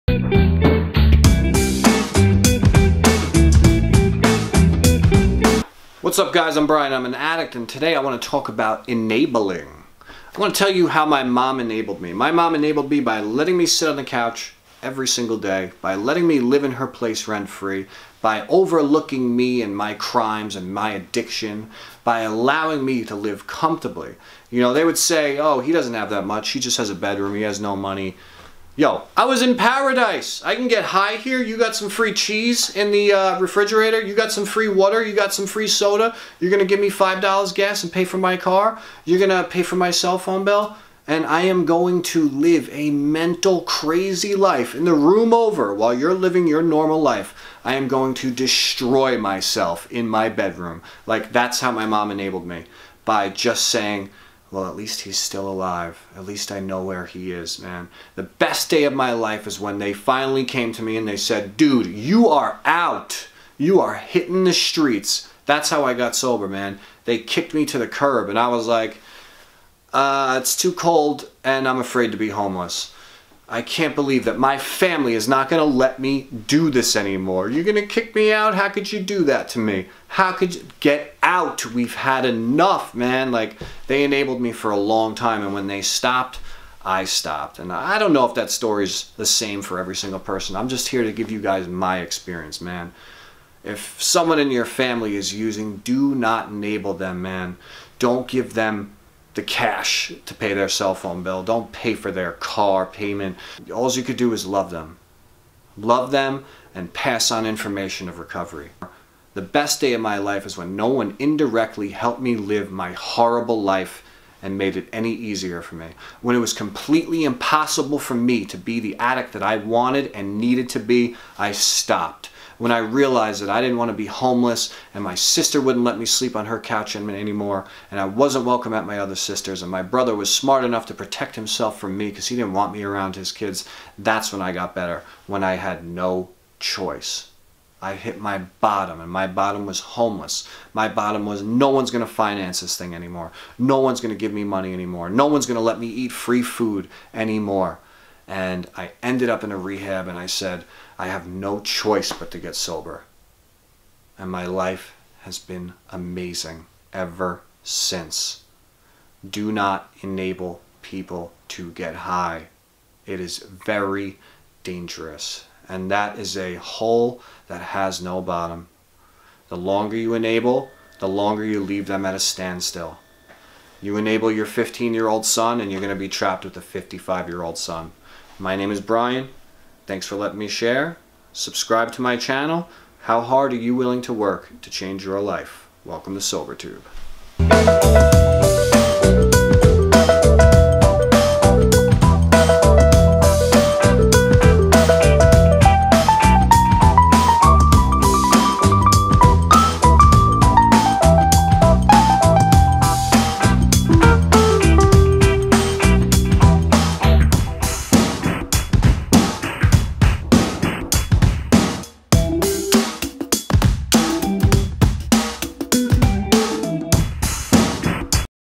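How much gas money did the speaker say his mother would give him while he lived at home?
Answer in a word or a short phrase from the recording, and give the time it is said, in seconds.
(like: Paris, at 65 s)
$5, at 36 s.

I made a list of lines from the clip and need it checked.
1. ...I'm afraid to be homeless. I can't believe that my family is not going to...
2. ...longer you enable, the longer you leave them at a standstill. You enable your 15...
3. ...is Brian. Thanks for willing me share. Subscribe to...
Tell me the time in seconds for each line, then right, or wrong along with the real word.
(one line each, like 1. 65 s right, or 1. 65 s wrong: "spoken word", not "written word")
1. 71 s right
2. 169 s right
3. 178 s wrong: "letting", not "willing".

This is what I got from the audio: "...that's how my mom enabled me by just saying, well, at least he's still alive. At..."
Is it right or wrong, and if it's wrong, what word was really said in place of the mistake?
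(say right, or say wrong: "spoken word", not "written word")
right.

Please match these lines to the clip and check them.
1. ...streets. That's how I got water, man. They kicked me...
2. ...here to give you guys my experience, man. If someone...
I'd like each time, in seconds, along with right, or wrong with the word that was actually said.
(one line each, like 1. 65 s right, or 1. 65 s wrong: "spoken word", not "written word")
1. 64 s wrong: "sober", not "water"
2. 90 s right.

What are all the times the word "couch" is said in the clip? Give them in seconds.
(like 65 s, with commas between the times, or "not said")
14 s, 126 s.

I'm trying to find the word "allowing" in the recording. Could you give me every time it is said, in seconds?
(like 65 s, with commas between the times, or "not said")
22 s.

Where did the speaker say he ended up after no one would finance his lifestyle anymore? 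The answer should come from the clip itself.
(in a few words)
a rehab.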